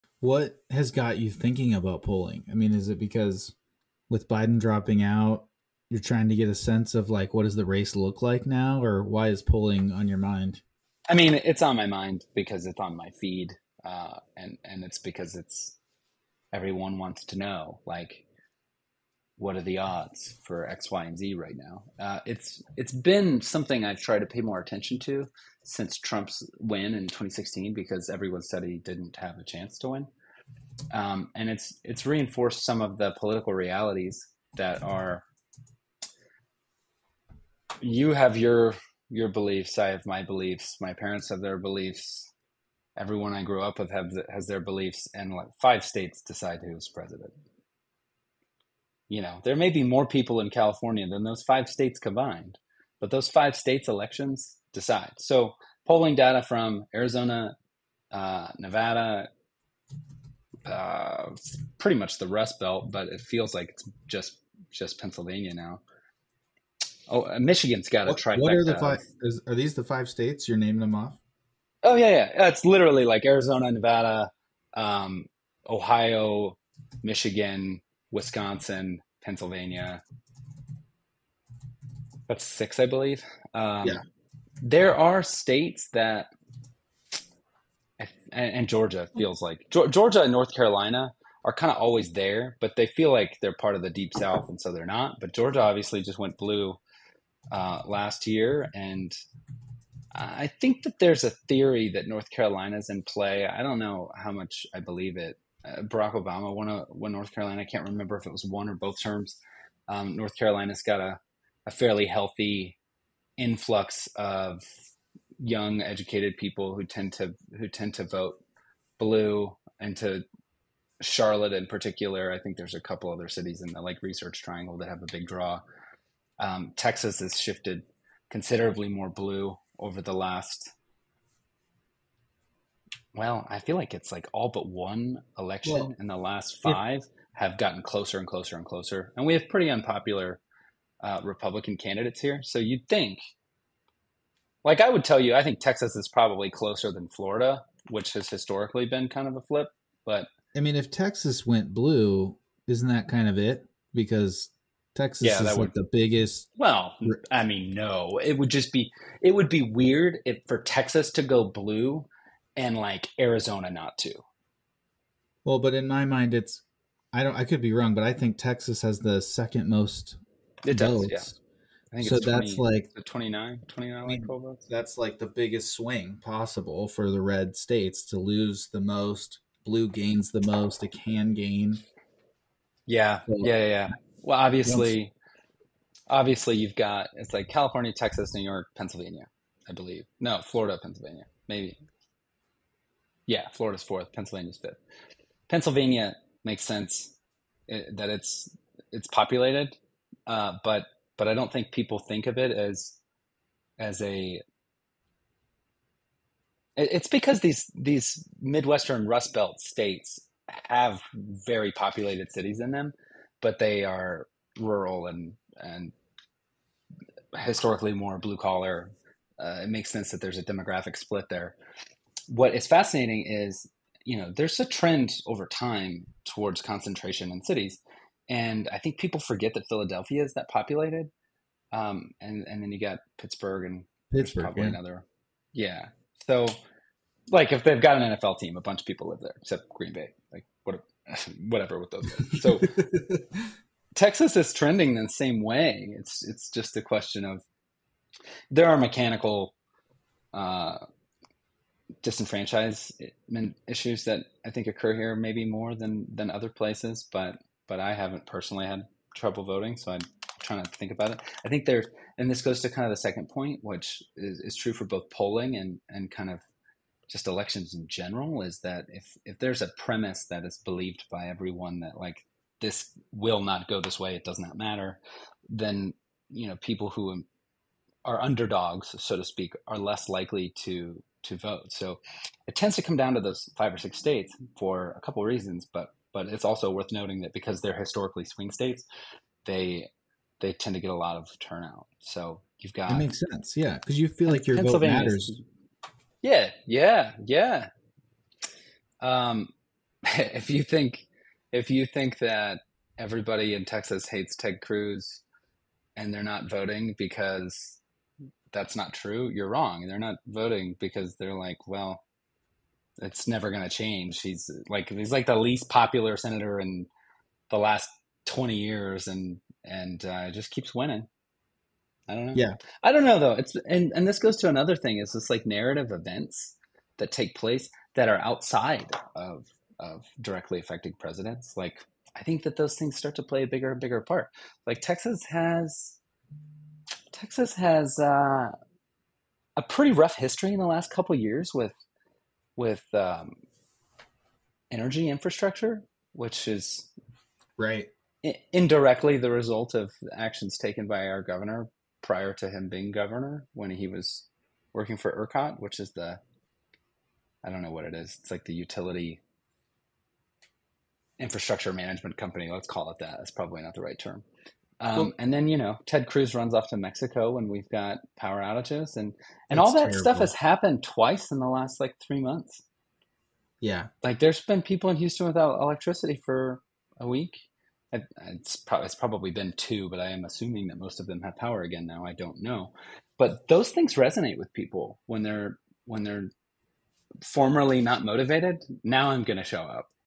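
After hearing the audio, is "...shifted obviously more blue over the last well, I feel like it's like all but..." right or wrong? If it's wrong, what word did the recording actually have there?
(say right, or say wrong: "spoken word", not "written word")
wrong: "considerably", not "obviously".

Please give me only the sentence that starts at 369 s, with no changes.
stuff has happened twice in the last like three months.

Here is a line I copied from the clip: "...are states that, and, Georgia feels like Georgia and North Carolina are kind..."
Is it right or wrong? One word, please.
right.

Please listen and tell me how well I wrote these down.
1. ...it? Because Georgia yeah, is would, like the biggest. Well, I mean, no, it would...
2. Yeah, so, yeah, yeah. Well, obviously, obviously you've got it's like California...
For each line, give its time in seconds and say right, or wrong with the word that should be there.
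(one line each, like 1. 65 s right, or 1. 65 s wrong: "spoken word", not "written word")
1. 153 s wrong: "Texas", not "Georgia"
2. 182 s right.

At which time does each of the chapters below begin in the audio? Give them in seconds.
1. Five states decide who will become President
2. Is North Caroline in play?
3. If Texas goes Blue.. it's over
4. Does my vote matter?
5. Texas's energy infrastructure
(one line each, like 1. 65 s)
1. 35 s
2. 100 s
3. 120 s
4. 260 s
5. 330 s.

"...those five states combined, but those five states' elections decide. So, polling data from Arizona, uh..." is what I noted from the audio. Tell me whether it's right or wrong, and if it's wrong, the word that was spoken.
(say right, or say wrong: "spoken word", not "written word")
right.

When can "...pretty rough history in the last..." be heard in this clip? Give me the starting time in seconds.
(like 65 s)
339 s.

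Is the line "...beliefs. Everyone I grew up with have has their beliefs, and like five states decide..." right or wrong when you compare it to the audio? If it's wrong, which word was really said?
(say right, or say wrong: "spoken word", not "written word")
right.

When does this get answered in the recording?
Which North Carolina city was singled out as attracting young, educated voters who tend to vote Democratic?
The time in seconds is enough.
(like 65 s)
121 s.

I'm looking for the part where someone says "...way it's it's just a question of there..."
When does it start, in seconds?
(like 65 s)
245 s.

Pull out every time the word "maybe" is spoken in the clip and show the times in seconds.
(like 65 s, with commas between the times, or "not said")
191 s, 255 s.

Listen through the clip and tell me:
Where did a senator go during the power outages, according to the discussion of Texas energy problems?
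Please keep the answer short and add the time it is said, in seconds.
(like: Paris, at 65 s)
Mexico, at 366 s.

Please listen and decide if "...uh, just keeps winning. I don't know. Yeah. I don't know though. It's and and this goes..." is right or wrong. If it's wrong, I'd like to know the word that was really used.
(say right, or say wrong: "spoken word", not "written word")
right.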